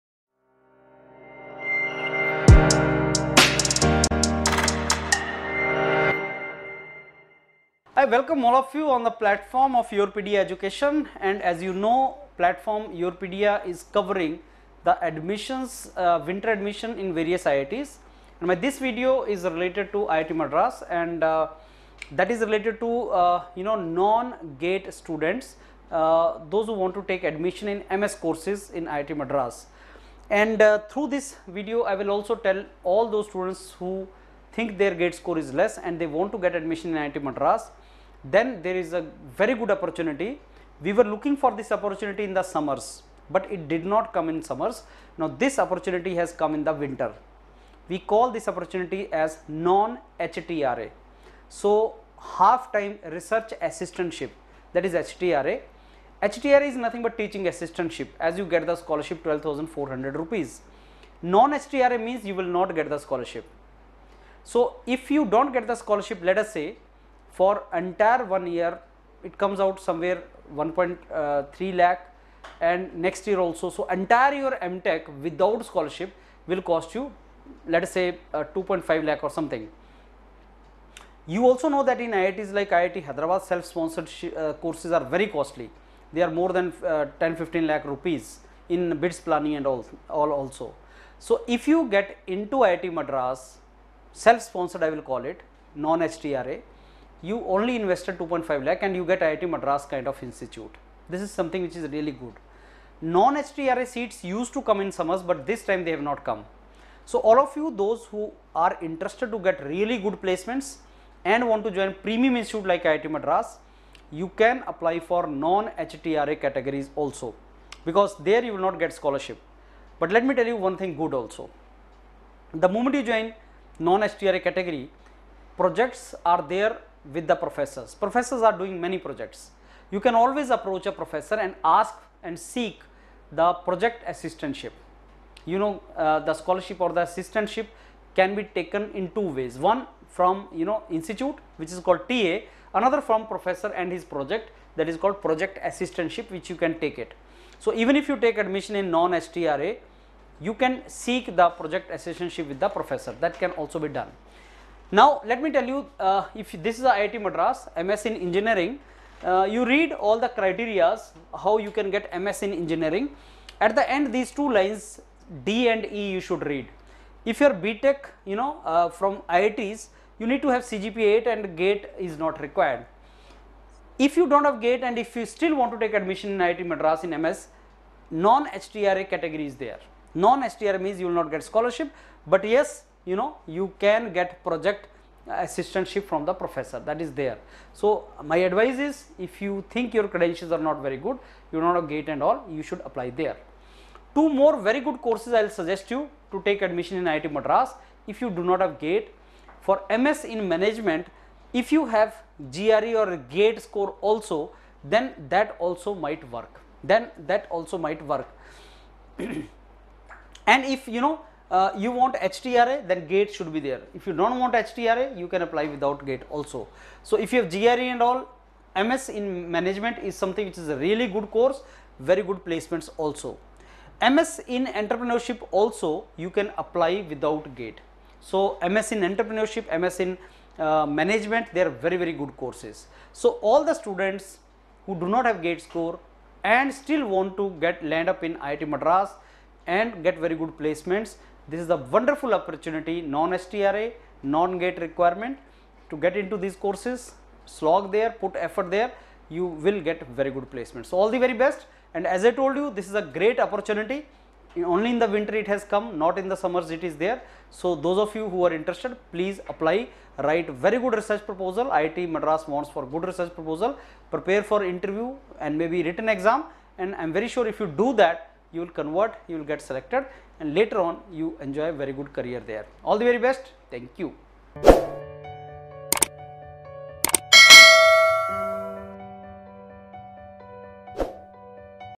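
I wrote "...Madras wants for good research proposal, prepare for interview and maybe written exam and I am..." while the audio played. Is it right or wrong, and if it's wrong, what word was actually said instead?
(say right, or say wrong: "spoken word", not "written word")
right.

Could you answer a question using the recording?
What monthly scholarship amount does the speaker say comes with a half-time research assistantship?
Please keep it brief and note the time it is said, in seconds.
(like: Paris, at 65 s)
12,400 rupees, at 59 s.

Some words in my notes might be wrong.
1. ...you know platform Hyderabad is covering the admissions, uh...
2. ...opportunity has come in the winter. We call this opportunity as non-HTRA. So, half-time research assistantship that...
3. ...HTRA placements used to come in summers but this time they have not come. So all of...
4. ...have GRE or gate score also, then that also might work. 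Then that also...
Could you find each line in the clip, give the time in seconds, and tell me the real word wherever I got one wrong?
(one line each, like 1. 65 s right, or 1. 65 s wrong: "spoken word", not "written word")
1. 11 s wrong: "YourPedia", not "Hyderabad"
2. 45 s right
3. 103 s wrong: "seats", not "placements"
4. 201 s right.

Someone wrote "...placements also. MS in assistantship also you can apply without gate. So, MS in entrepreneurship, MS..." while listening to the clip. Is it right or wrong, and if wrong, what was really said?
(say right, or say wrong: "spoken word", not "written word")
wrong: "entrepreneurship", not "assistantship".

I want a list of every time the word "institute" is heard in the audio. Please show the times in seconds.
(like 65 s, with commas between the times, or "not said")
100 s, 112 s, 140 s.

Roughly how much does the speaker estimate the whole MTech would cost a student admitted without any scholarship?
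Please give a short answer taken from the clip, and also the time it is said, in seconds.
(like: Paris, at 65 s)
2.5 lakh, at 78 s.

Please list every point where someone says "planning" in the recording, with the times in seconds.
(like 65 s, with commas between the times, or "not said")
89 s.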